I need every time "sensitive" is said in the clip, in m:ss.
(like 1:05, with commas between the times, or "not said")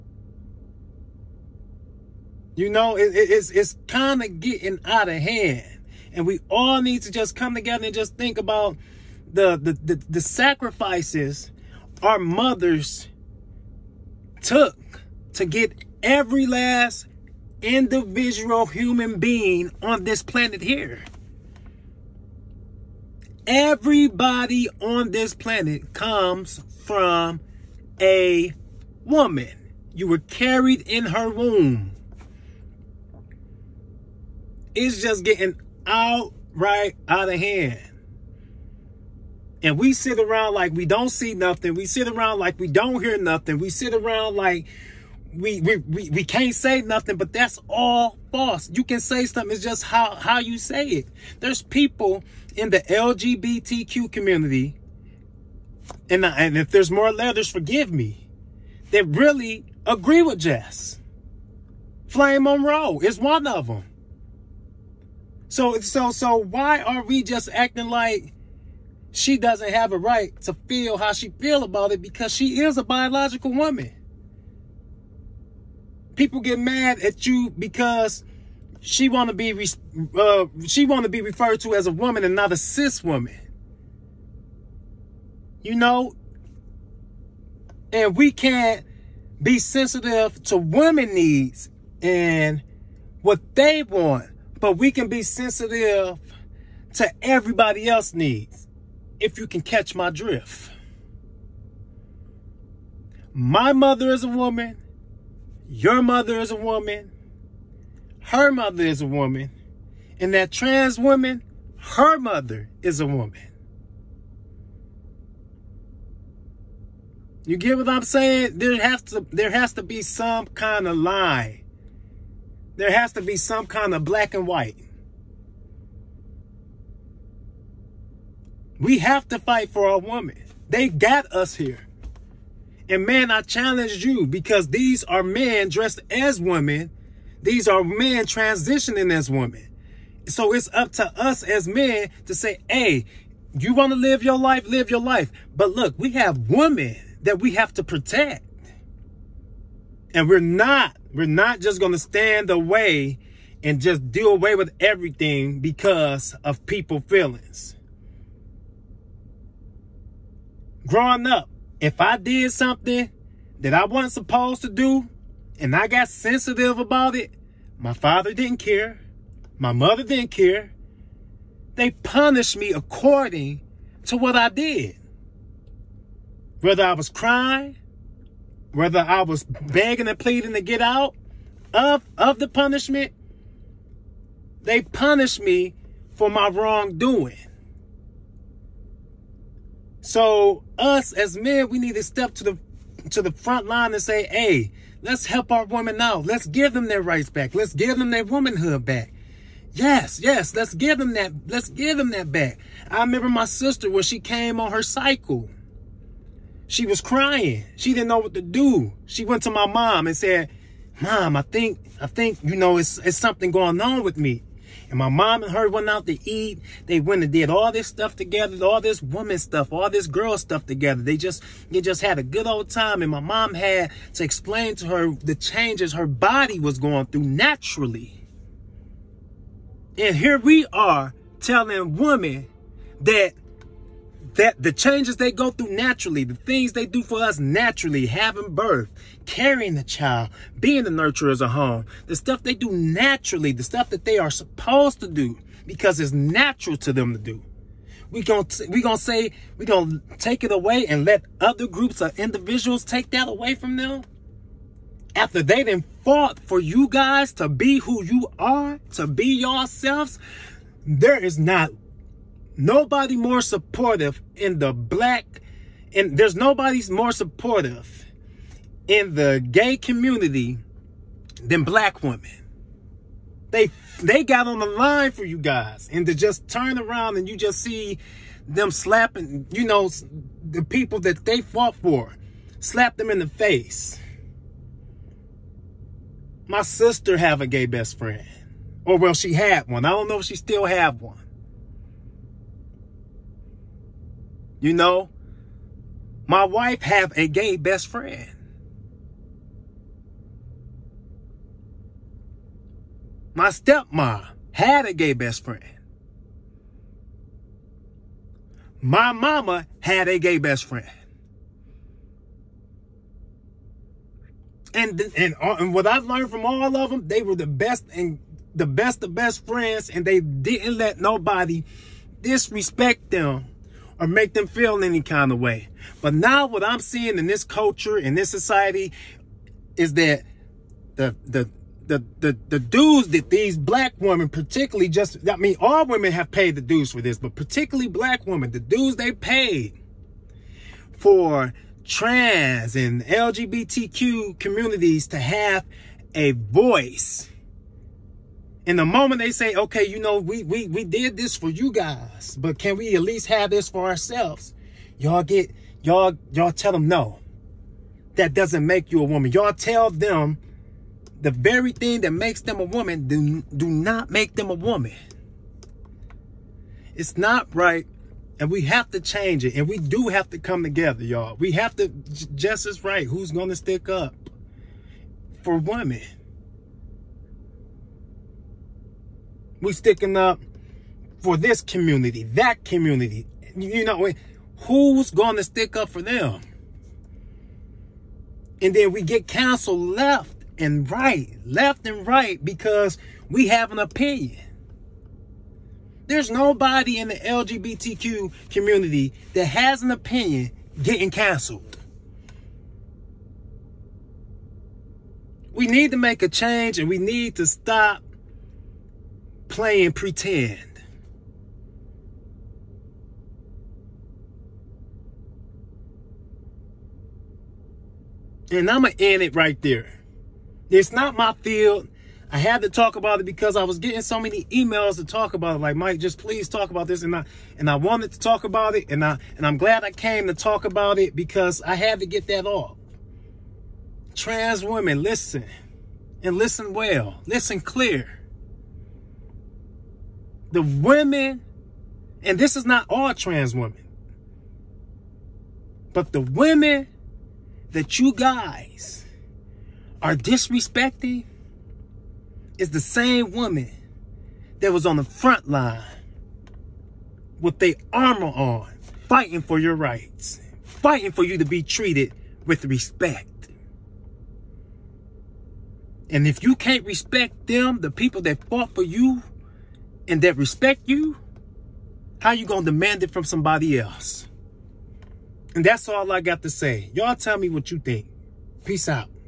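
1:29, 1:35, 2:46.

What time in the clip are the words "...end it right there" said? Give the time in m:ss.
6:59.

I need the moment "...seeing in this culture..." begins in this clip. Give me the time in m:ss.
5:26.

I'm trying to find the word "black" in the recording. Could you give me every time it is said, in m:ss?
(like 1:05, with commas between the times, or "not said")
2:04, 4:24, 4:31, 5:33, 5:37.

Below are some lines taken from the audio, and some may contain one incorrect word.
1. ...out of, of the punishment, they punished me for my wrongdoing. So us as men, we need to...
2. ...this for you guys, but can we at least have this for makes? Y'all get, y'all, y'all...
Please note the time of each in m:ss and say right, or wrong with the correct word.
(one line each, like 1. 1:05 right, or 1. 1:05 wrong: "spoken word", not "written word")
1. 3:00 right
2. 5:51 wrong: "ourselves", not "makes".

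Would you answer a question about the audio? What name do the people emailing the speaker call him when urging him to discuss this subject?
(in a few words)
Mike.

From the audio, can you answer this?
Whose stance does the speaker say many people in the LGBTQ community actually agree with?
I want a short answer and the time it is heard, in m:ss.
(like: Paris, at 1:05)
Jess, at 1:00.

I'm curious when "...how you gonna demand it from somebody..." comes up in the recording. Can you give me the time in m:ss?
7:52.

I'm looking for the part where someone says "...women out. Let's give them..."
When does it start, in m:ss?
3:15.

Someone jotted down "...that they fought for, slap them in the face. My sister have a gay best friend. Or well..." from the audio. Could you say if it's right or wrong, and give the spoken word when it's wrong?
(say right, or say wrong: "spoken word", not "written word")
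right.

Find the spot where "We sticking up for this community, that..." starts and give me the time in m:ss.
6:19.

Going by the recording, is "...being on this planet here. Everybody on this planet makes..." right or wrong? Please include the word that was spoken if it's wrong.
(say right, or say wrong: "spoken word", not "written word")
wrong: "comes", not "makes".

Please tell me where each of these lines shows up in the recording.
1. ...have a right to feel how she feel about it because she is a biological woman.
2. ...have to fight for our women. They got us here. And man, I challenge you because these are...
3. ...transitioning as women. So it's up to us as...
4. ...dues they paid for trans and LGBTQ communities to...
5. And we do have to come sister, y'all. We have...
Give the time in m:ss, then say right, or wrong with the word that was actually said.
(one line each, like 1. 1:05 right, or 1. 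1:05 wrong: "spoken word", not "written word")
1. 1:09 right
2. 2:08 right
3. 2:18 right
4. 5:38 right
5. 6:09 wrong: "together", not "sister".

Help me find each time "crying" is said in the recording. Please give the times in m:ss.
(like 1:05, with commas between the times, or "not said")
2:57, 3:27.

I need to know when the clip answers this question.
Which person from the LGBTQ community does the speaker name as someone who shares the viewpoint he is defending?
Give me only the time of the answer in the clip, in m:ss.
1:02.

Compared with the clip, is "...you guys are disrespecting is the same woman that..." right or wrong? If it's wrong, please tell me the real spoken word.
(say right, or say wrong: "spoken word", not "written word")
right.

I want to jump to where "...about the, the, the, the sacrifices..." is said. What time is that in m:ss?
0:08.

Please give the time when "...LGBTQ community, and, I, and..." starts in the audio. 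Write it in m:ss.
0:52.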